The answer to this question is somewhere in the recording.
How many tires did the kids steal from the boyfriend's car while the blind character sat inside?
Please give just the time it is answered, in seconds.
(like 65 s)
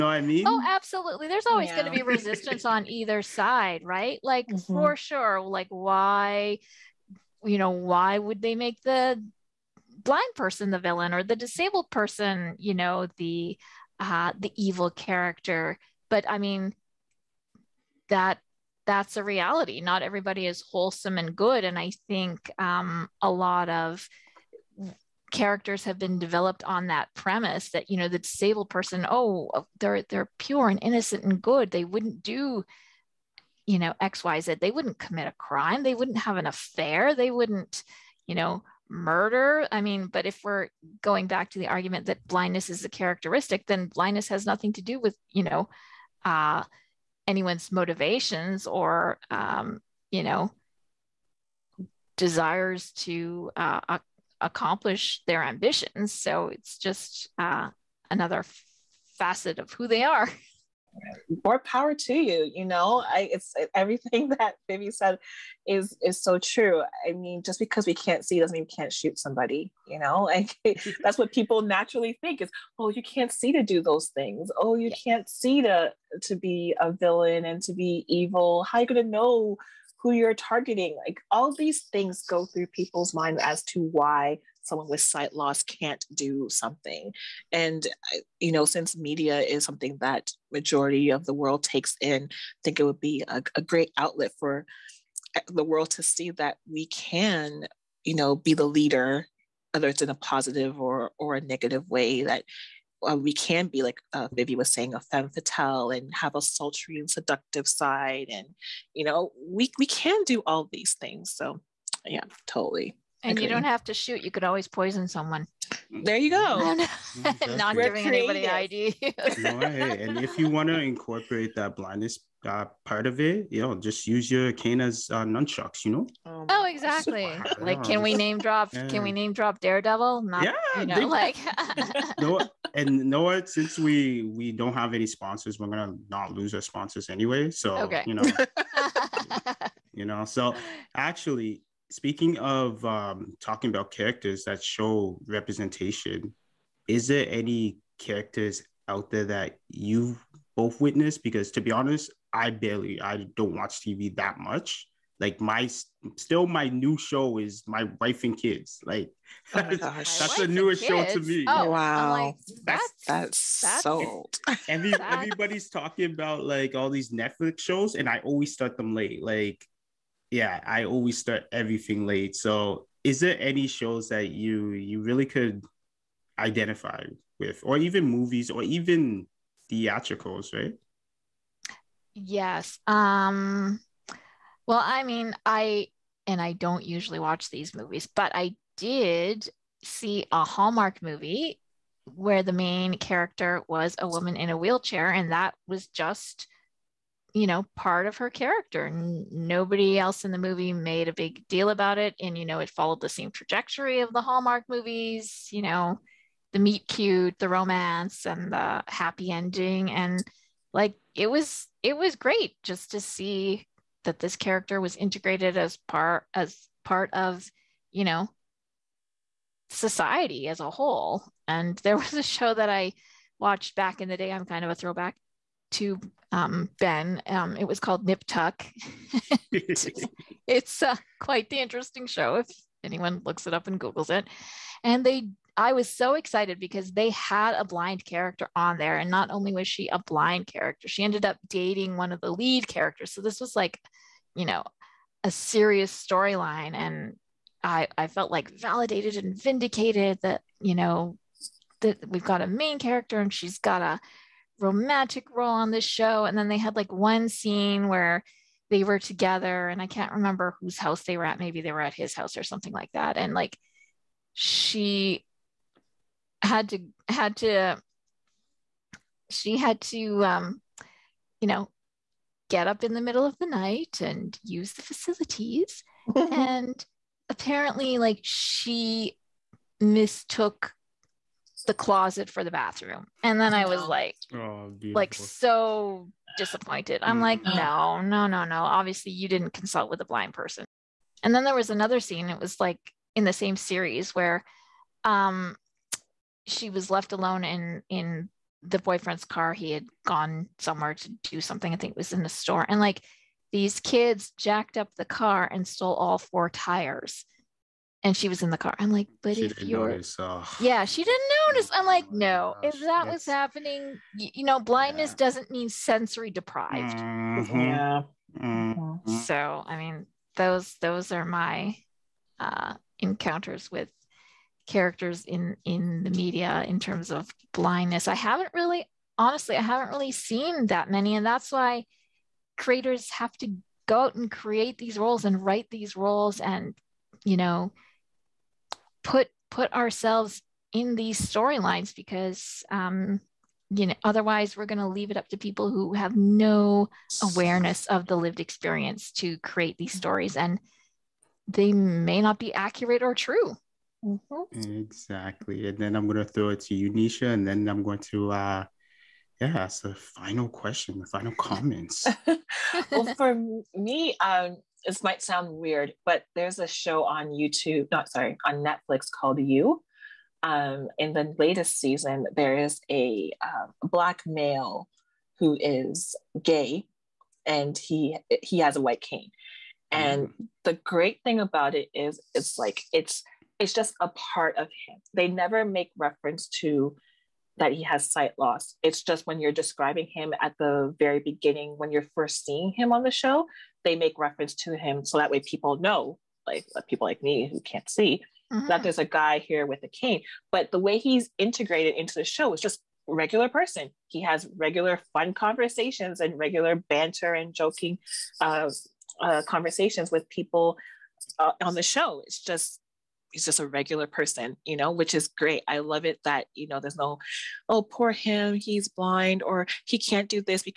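306 s.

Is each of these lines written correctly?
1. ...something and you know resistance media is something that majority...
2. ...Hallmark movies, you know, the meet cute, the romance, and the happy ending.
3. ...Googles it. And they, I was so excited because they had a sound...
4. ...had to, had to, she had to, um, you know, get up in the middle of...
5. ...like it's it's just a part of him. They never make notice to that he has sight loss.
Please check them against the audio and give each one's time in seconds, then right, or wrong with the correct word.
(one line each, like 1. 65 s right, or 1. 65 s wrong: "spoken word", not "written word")
1. 86 s wrong: "since", not "resistance"
2. 204 s right
3. 233 s wrong: "blind", not "sound"
4. 266 s right
5. 382 s wrong: "reference", not "notice".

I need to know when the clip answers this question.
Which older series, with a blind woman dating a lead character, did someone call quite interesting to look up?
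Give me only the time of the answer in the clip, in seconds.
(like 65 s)
228 s.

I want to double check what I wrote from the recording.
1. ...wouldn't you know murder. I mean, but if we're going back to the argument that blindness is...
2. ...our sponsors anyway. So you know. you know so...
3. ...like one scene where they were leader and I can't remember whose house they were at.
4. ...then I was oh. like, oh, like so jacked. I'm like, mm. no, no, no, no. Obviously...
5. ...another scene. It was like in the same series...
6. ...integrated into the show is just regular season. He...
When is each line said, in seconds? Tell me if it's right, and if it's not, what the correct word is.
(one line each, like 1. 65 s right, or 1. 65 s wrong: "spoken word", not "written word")
1. 37 s right
2. 136 s right
3. 256 s wrong: "together", not "leader"
4. 283 s wrong: "disappointed", not "jacked"
5. 291 s right
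6. 401 s wrong: "person", not "season".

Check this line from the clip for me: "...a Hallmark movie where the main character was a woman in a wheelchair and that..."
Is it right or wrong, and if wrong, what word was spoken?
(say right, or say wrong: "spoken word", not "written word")
right.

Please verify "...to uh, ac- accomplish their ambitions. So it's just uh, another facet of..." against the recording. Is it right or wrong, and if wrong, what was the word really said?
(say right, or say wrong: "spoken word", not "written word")
right.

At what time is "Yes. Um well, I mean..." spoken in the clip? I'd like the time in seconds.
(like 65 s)
182 s.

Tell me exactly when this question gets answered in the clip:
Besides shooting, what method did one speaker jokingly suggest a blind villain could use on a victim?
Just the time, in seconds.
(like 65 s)
114 s.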